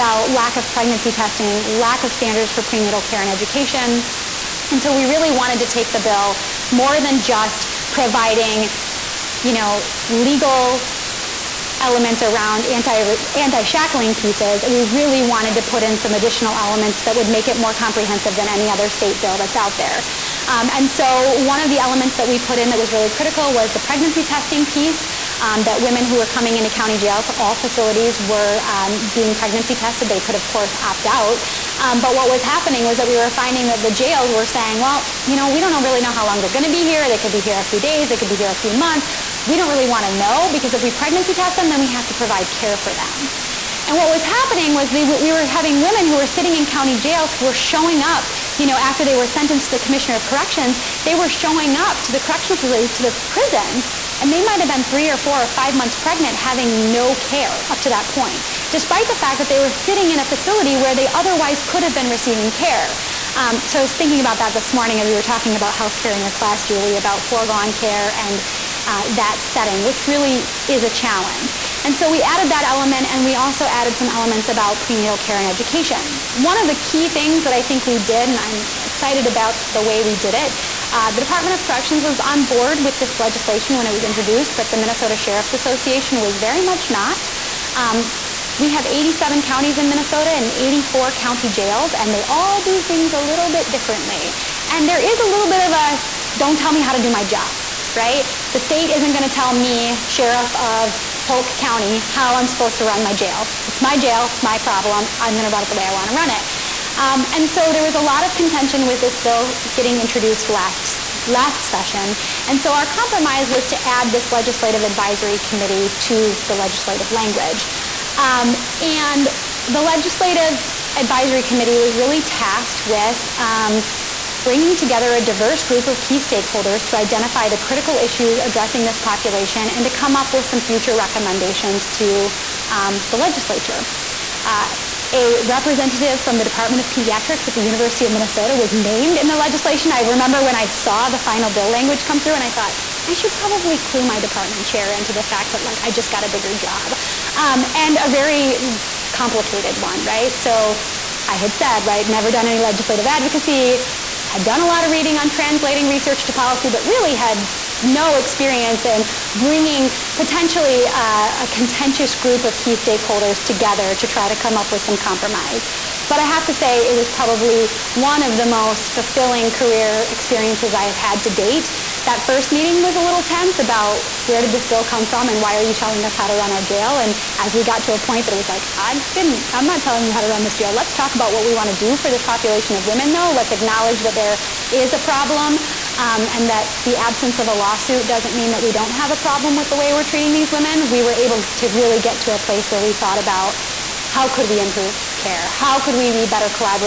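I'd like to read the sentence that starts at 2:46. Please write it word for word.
But I have to say it was probably one of the most fulfilling career experiences I have had to date.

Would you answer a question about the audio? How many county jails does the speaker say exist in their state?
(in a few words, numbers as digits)
84.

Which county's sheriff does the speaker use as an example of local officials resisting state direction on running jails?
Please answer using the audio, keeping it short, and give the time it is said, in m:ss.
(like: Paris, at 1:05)
Polk County, at 1:41.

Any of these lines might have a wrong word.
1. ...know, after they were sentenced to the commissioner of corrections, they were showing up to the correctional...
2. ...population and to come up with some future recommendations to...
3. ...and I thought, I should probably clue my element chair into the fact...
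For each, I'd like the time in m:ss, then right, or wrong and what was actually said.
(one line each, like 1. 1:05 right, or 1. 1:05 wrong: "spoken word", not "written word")
1. 0:48 right
2. 2:08 right
3. 2:22 wrong: "department", not "element".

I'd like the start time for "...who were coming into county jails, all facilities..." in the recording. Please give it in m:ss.
0:26.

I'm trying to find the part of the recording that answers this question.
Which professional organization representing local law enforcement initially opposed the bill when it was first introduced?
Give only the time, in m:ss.
1:24.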